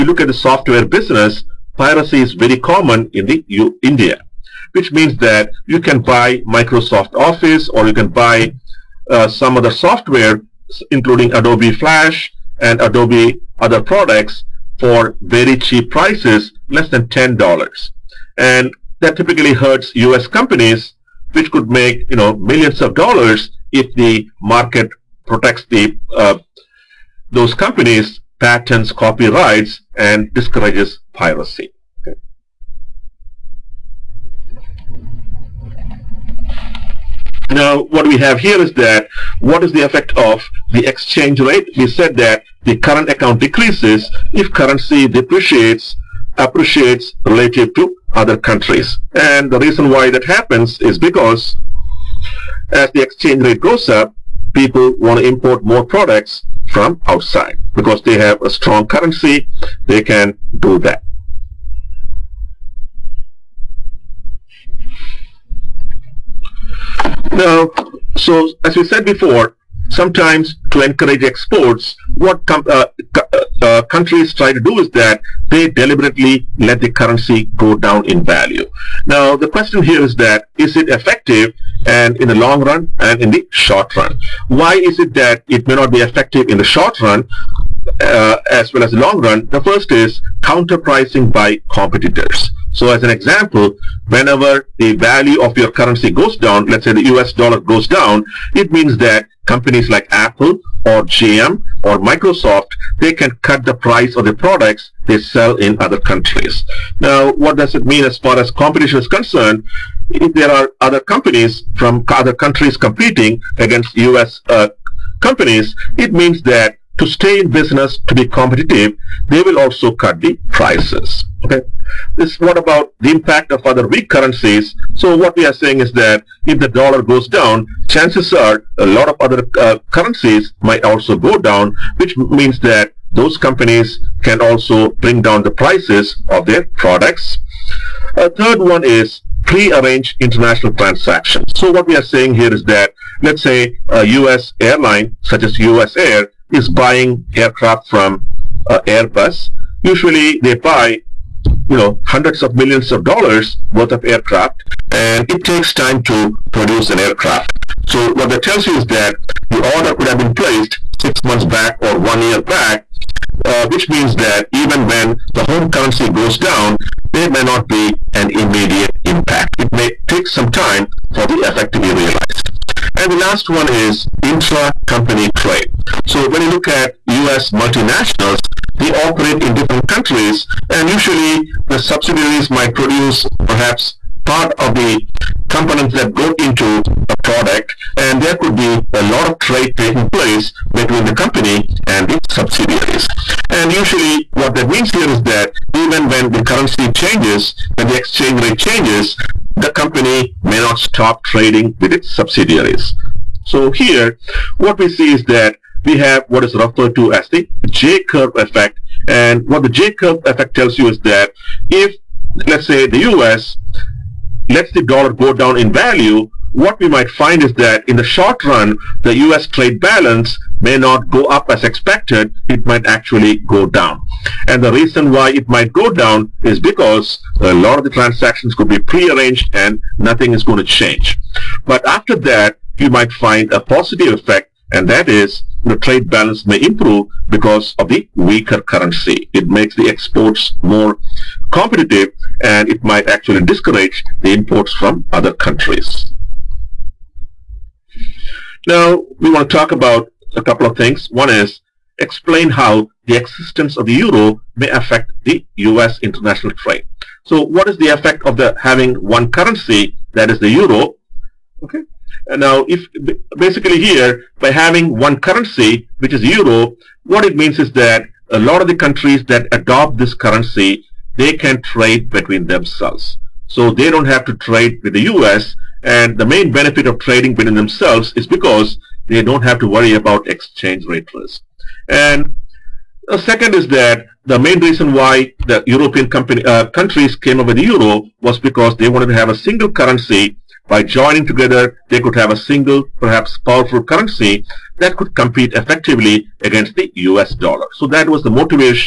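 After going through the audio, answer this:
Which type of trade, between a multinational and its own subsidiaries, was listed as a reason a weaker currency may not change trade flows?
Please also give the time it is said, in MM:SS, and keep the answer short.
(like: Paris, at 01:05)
intra-company trade, at 02:54.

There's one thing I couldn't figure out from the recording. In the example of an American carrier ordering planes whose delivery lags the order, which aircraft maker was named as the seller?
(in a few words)
Airbus.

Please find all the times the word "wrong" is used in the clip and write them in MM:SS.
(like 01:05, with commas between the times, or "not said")
not said.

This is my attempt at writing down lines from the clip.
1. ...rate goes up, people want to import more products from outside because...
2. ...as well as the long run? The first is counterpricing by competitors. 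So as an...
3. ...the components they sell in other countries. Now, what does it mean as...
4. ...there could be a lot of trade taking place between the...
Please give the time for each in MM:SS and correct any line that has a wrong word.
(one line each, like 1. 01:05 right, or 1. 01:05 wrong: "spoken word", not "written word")
1. 00:53 right
2. 01:28 right
3. 01:44 wrong: "products", not "components"
4. 03:08 right.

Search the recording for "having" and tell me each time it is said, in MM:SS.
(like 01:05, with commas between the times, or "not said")
04:18, 04:24.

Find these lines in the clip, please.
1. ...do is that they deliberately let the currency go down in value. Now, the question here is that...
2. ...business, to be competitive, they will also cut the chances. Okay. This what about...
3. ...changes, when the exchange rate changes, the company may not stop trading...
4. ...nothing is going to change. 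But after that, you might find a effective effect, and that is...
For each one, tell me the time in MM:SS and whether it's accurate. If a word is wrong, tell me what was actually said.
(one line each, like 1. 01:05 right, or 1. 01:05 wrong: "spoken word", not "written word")
1. 01:14 right
2. 01:57 wrong: "prices", not "chances"
3. 03:16 right
4. 03:49 wrong: "positive", not "effective".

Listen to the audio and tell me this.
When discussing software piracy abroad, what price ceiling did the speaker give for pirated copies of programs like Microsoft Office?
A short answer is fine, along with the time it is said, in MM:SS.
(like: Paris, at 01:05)
less than $10, at 00:16.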